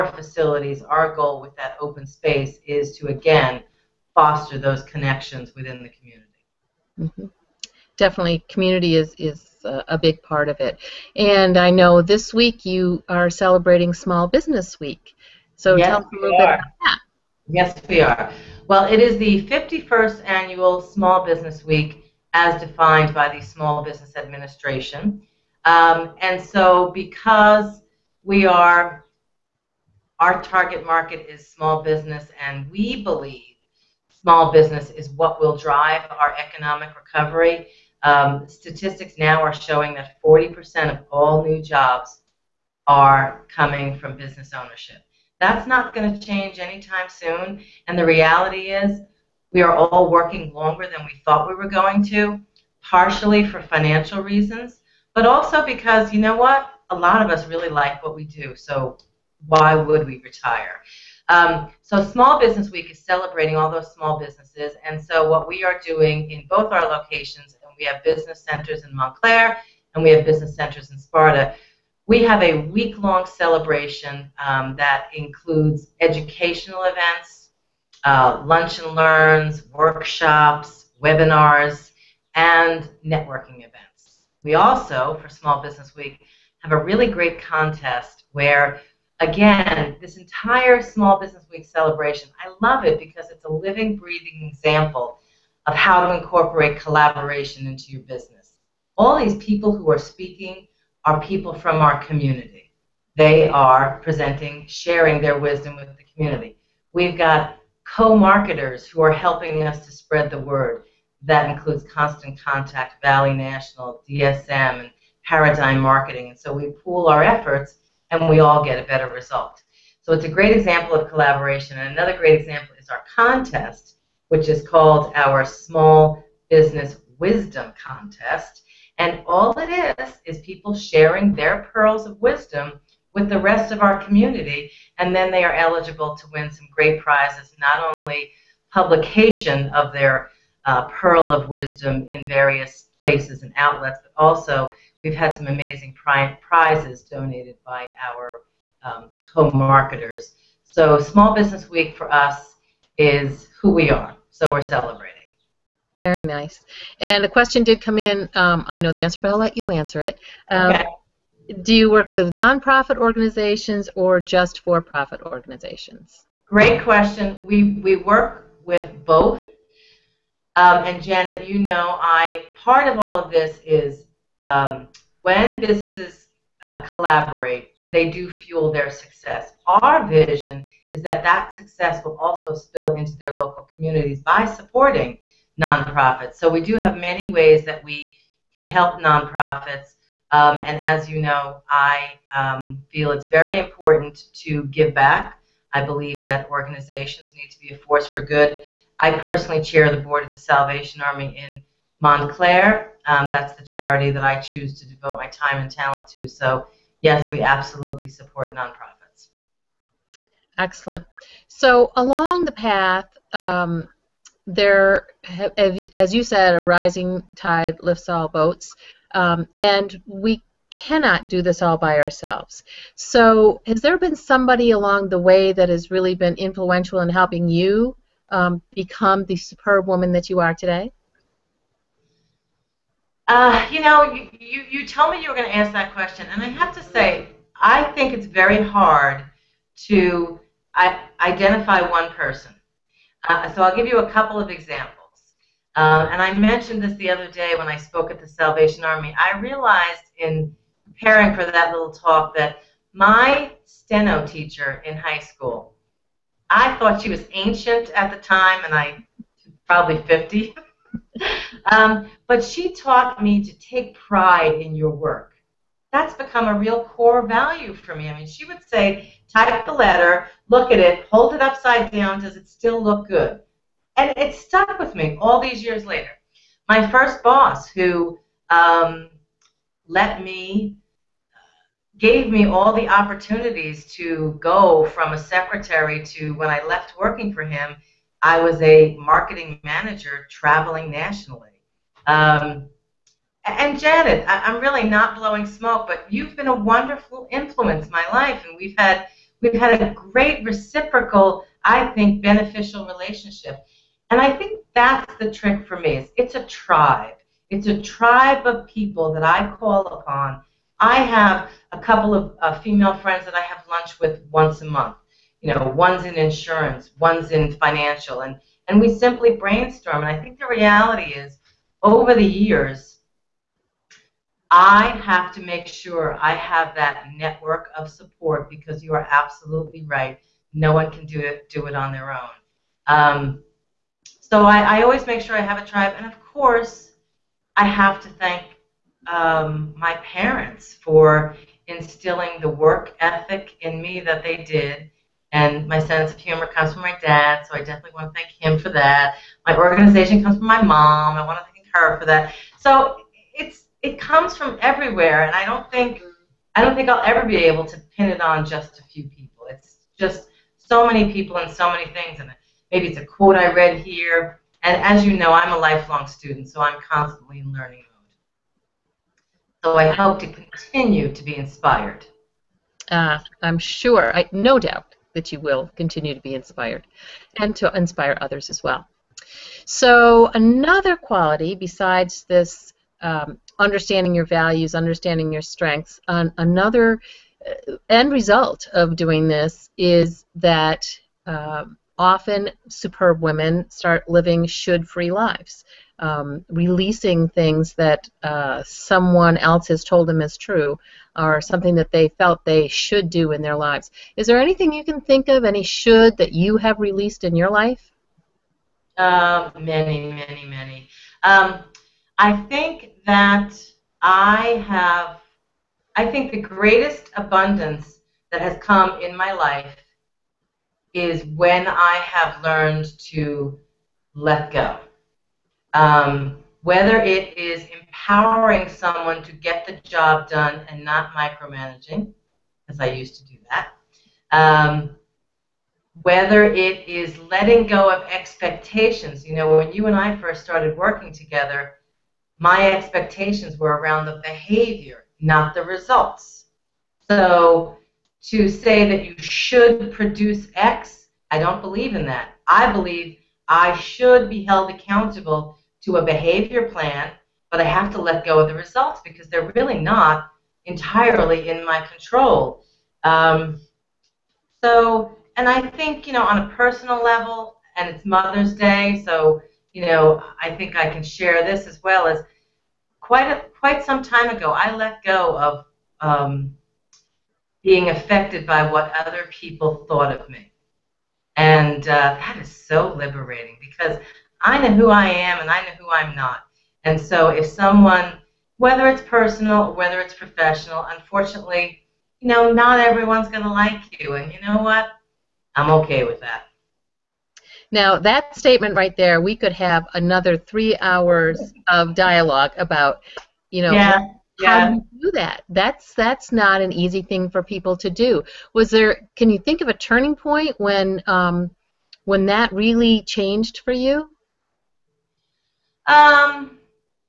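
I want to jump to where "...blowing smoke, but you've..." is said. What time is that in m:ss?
4:55.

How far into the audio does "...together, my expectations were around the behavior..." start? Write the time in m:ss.
7:21.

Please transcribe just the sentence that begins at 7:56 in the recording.
Um, being affected by what other people thought of me.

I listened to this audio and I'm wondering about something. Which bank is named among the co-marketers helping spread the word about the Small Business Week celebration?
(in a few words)
Valley National.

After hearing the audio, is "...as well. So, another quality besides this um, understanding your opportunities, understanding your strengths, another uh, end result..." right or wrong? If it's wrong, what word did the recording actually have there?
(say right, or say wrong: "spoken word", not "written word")
wrong: "values", not "opportunities".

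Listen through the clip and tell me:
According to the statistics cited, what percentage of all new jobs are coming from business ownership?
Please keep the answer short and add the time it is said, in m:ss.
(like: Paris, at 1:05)
40%, at 0:40.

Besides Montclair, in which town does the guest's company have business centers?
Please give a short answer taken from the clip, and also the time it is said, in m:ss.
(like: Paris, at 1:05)
Sparta, at 1:10.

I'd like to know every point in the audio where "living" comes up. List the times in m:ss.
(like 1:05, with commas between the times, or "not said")
1:33, 6:34.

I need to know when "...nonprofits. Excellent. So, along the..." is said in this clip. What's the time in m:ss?
3:28.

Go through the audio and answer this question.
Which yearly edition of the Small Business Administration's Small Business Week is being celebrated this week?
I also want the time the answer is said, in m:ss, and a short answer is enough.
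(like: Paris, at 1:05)
51st, at 0:19.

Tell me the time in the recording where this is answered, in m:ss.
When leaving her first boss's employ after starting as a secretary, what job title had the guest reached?
4:48.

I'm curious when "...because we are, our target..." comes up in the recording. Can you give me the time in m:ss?
0:26.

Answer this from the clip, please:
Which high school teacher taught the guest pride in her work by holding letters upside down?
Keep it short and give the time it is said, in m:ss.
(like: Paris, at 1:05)
steno teacher, at 4:13.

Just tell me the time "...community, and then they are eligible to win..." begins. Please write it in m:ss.
2:14.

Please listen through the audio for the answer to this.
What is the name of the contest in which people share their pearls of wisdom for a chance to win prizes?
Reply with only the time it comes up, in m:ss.
2:05.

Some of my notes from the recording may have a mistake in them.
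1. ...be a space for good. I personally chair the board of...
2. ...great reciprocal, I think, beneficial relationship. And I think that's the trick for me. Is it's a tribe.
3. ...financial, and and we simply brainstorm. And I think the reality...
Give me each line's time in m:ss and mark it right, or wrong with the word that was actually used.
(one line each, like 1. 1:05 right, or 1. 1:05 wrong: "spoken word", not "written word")
1. 3:17 wrong: "force", not "space"
2. 4:59 right
3. 5:17 right.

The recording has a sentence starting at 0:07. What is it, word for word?
Definitely, community is, is a big part of it.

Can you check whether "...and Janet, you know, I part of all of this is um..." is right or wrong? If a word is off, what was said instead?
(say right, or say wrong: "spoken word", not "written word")
right.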